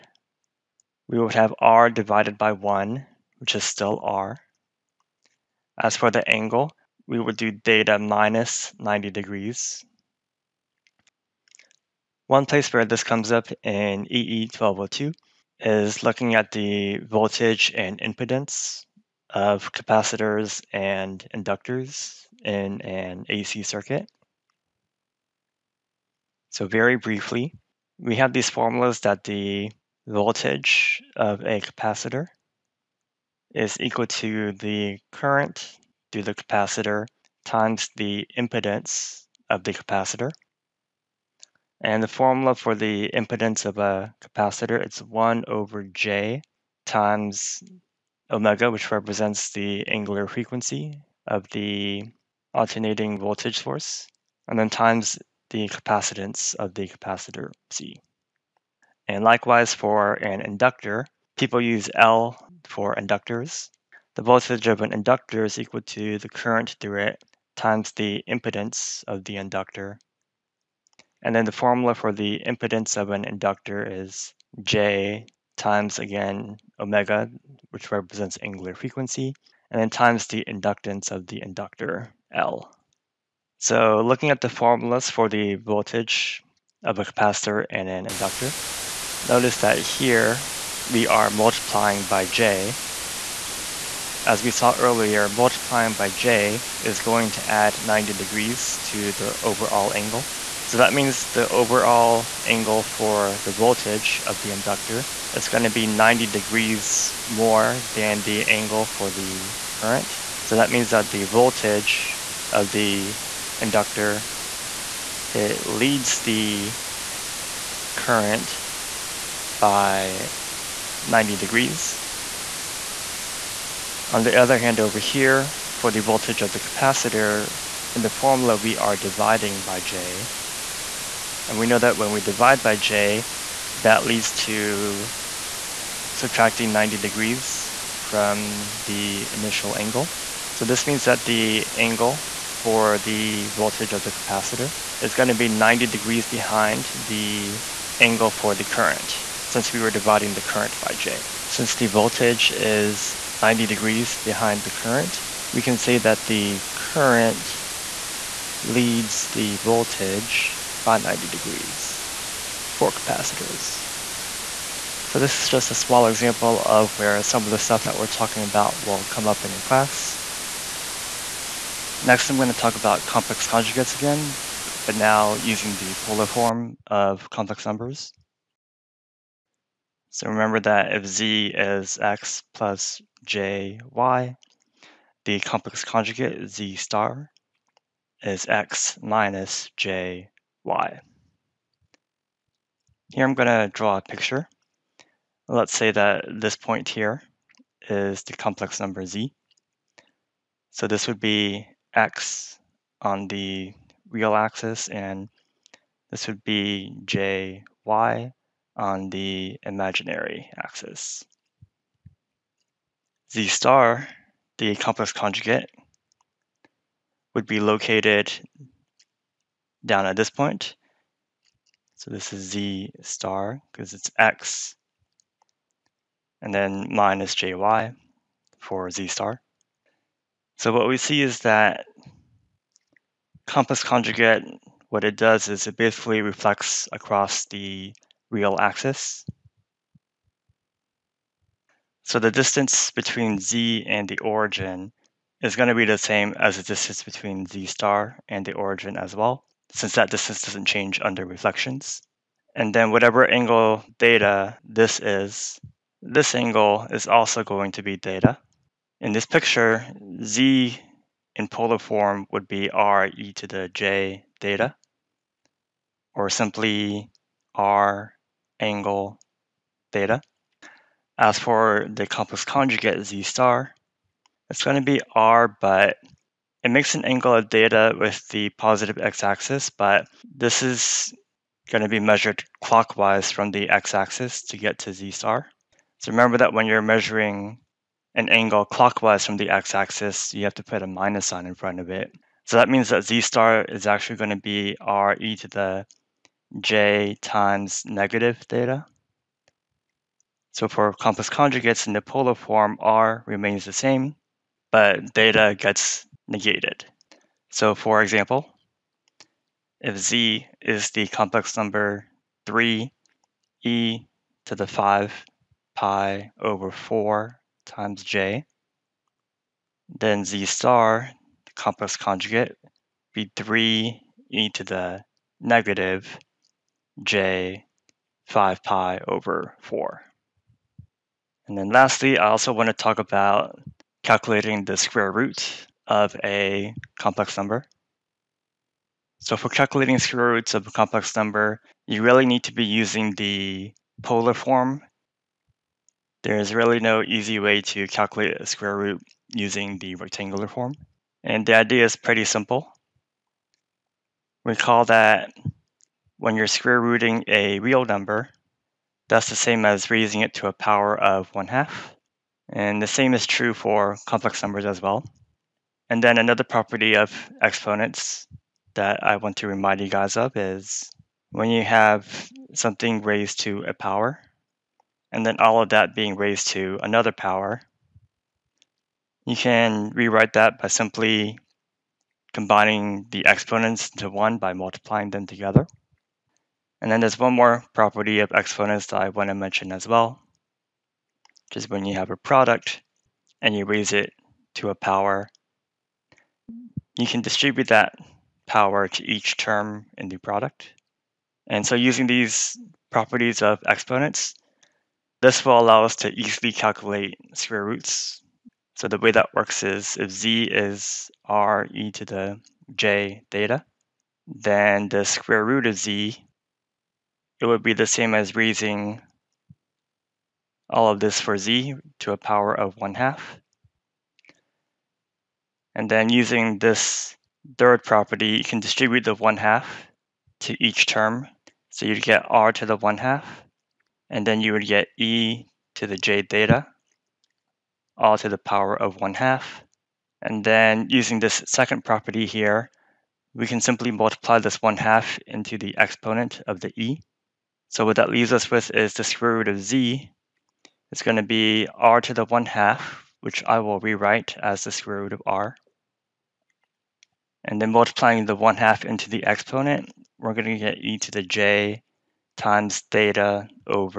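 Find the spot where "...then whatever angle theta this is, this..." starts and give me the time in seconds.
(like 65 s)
252 s.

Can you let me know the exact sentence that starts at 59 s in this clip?
And likewise for an inductor, people use L for inductors.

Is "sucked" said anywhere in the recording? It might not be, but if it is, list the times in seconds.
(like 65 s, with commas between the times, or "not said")
not said.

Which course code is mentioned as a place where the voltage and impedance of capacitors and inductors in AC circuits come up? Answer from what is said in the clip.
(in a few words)
EE 1202.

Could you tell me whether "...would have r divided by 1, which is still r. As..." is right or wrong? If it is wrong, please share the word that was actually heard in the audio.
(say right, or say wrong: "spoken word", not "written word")
right.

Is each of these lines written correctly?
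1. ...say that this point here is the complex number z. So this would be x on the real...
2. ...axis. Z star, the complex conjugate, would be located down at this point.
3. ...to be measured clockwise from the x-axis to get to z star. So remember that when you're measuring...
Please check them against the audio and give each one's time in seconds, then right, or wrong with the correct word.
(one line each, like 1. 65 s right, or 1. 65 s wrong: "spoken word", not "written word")
1. 195 s right
2. 210 s right
3. 281 s right.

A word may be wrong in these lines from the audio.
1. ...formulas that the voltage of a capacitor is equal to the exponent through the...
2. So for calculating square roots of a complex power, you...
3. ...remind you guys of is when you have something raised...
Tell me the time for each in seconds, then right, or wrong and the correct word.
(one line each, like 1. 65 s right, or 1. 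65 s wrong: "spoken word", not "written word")
1. 28 s wrong: "current", not "exponent"
2. 339 s wrong: "number", not "power"
3. 369 s right.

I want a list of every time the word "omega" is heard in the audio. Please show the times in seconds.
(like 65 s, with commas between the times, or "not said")
48 s, 76 s.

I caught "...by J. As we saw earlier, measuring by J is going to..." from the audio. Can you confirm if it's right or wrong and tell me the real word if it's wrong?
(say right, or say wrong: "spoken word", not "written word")
wrong: "multiplying", not "measuring".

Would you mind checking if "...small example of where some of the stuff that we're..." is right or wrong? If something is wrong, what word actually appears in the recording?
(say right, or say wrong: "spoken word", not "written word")
right.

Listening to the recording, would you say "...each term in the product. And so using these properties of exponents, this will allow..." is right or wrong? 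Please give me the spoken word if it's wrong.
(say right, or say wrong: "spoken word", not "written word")
right.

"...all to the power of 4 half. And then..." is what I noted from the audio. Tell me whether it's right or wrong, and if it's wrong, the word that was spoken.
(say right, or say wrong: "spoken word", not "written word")
wrong: "1", not "4".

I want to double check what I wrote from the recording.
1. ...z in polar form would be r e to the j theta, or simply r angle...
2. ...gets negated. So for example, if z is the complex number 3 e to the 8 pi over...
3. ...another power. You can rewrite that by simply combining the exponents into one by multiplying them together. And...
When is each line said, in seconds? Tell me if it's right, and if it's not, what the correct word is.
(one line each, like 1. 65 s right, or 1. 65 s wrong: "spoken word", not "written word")
1. 260 s right
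2. 305 s wrong: "5", not "8"
3. 376 s right.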